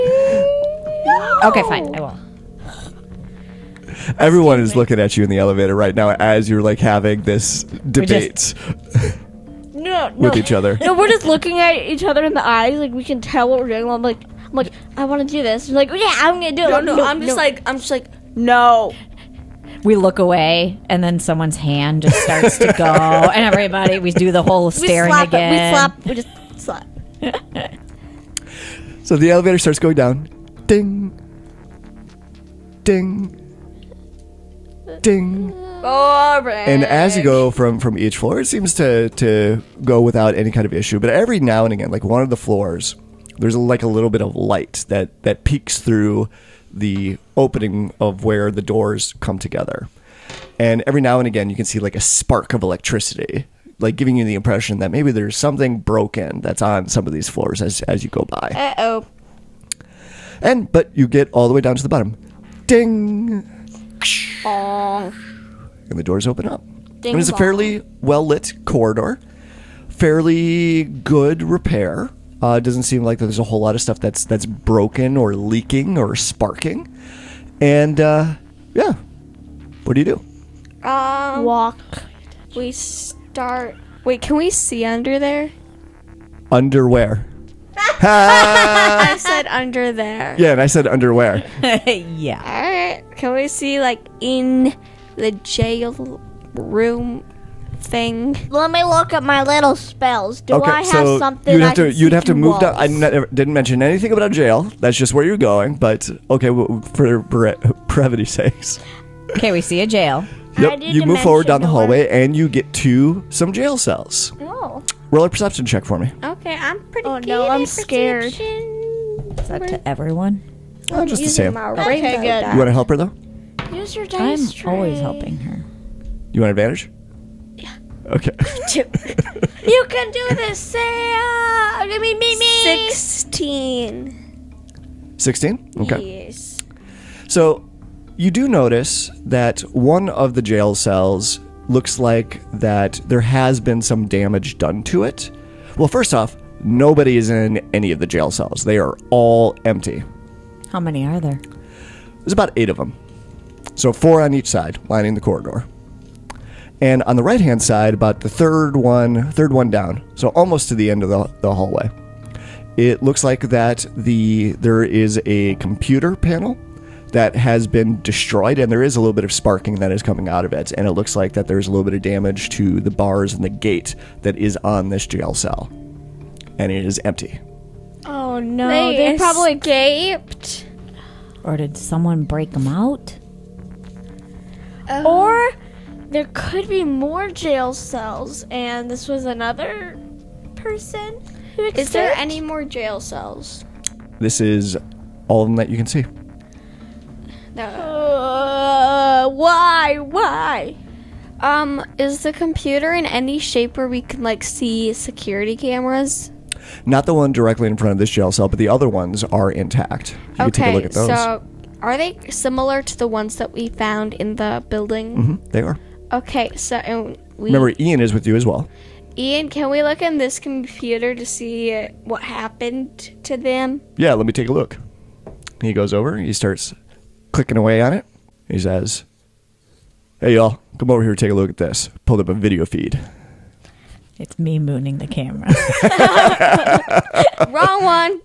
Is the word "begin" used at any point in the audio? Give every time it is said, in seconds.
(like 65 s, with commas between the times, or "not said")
not said.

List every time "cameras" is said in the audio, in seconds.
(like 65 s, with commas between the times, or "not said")
205 s, 235 s.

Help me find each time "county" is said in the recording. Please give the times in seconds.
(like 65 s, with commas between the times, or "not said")
not said.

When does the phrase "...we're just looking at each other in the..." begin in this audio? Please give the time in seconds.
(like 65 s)
10 s.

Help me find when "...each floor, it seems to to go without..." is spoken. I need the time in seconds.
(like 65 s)
37 s.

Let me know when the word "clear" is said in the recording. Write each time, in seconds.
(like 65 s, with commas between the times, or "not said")
not said.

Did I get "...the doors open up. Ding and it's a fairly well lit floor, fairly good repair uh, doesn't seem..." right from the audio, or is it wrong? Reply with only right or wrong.
wrong.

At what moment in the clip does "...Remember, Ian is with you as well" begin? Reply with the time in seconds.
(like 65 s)
217 s.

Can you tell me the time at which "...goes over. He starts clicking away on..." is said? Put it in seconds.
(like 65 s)
225 s.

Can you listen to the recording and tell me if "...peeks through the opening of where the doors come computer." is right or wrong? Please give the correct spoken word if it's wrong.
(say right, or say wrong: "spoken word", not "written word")
wrong: "together", not "computer".